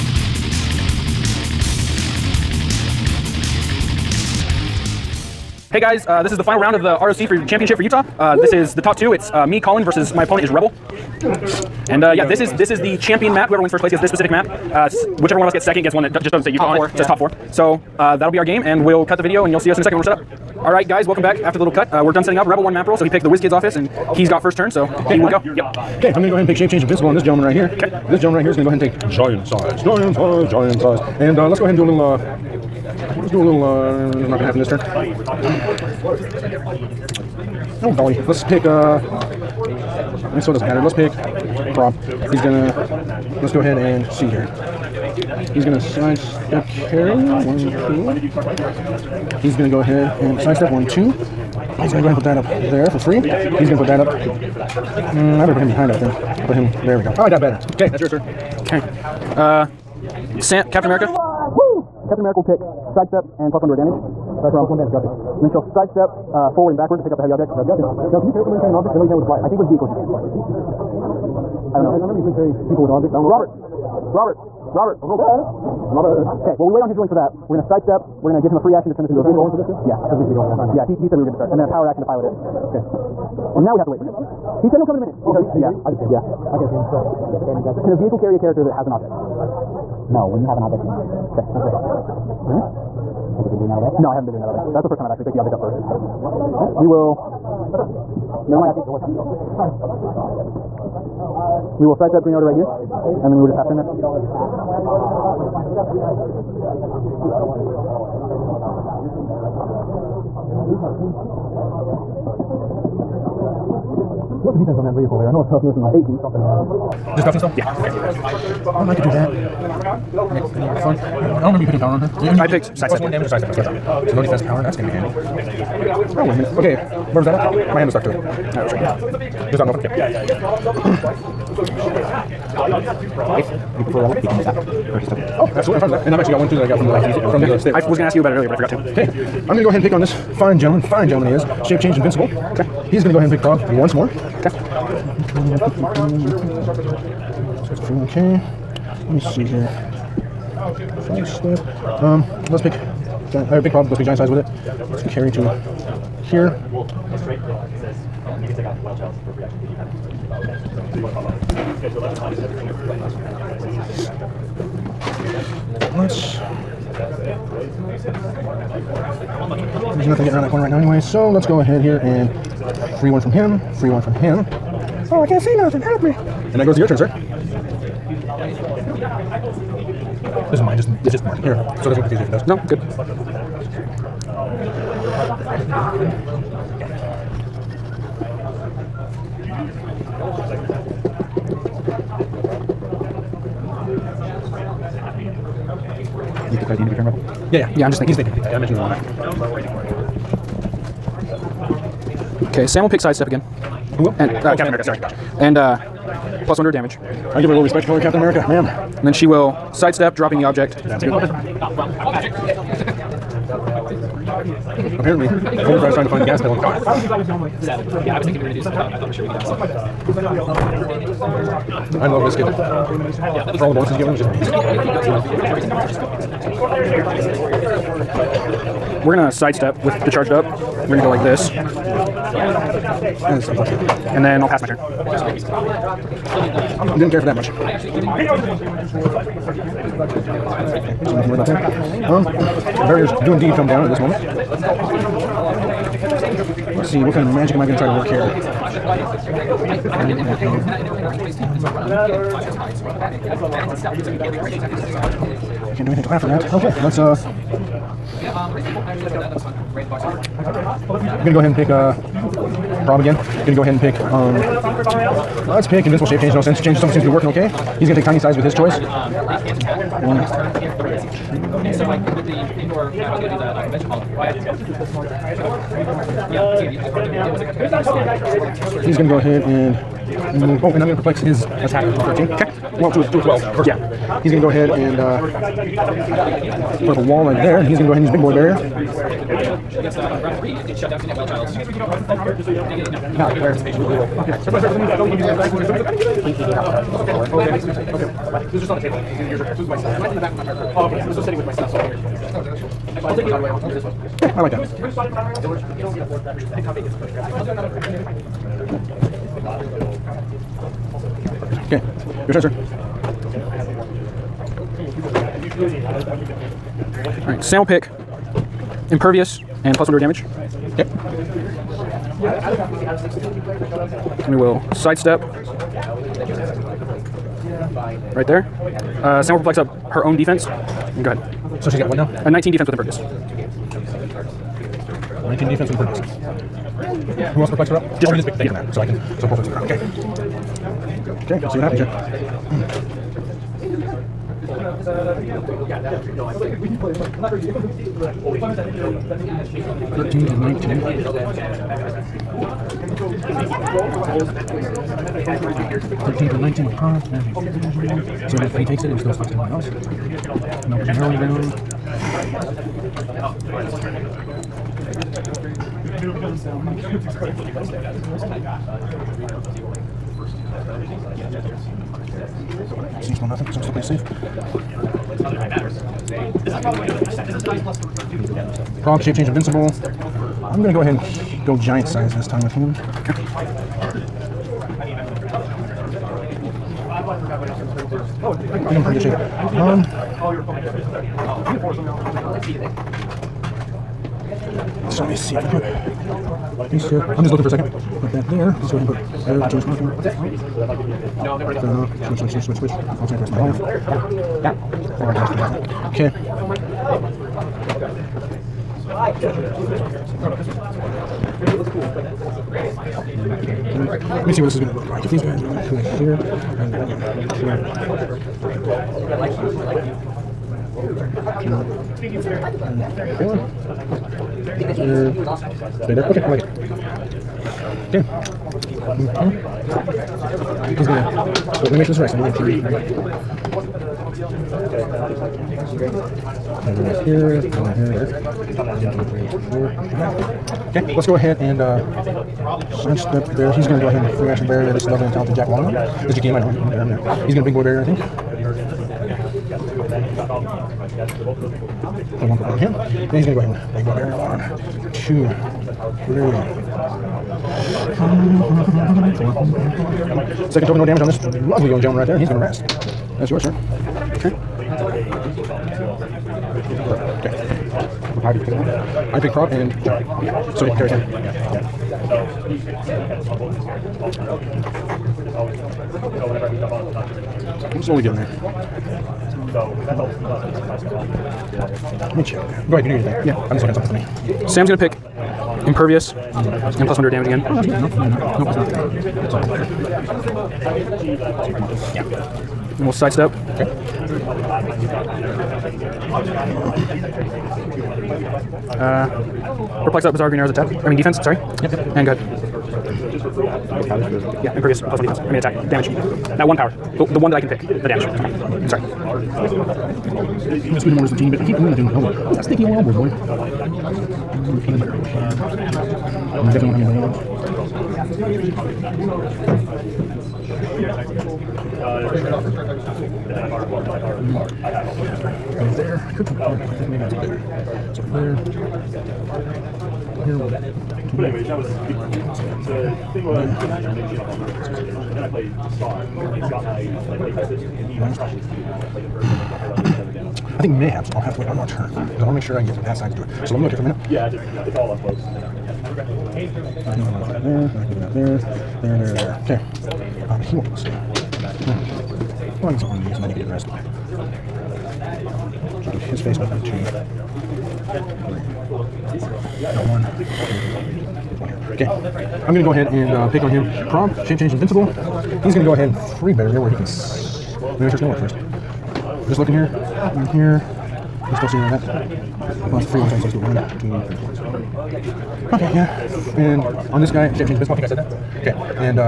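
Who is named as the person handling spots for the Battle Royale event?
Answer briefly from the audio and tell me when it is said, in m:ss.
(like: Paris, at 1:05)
George, at 5:05.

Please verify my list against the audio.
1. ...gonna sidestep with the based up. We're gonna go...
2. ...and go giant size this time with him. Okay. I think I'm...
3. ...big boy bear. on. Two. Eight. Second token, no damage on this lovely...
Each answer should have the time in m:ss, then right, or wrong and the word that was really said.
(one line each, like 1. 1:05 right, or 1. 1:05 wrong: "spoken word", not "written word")
1. 3:49 wrong: "charged", not "based"
2. 6:20 right
3. 7:33 wrong: "Three", not "Eight".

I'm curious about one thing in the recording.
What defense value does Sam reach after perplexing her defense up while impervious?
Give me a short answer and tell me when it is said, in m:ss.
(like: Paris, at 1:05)
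19, at 5:32.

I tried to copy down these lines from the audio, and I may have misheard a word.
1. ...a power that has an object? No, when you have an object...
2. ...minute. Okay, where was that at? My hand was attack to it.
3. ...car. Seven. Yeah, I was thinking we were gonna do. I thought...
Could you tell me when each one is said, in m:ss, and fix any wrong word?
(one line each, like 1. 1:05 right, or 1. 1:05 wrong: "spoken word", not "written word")
1. 1:28 wrong: "character", not "power"
2. 2:06 wrong: "stuck", not "attack"
3. 3:36 right.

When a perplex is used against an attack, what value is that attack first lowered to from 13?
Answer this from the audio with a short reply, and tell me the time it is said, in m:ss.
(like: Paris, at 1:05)
12, at 4:43.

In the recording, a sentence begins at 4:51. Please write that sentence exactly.
Did you guys already give out prizes then, Robert?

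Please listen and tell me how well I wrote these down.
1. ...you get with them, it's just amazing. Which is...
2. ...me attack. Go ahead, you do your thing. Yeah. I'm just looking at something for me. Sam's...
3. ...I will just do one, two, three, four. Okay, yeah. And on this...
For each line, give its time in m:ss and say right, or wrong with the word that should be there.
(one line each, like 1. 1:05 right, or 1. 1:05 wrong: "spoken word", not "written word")
1. 3:43 right
2. 8:02 wrong: "check", not "attack"
3. 9:33 right.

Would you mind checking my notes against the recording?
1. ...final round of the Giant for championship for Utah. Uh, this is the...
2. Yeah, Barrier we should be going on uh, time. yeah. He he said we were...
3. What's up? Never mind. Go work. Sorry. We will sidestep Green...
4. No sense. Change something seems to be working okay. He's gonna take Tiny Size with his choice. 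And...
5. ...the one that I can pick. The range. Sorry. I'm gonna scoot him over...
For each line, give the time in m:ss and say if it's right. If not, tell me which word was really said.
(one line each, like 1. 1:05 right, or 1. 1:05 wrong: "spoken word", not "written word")
1. 0:06 wrong: "ROC", not "Giant"
2. 1:19 wrong: "Because", not "Barrier"
3. 1:37 right
4. 4:26 right
5. 8:27 wrong: "damage", not "range".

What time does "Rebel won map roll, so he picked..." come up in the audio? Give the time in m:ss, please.
0:22.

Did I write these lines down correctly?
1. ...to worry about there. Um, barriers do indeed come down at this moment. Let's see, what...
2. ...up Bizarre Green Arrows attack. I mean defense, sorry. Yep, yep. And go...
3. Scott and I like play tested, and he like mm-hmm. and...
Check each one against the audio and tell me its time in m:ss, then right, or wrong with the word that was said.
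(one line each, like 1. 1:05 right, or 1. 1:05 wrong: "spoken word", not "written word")
1. 4:01 right
2. 8:20 right
3. 8:56 right.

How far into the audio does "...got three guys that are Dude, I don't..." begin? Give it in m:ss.
1:45.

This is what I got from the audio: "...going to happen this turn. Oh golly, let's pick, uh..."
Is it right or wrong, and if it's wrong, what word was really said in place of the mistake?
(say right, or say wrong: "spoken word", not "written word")
right.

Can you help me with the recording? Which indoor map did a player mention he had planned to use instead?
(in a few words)
convention hall.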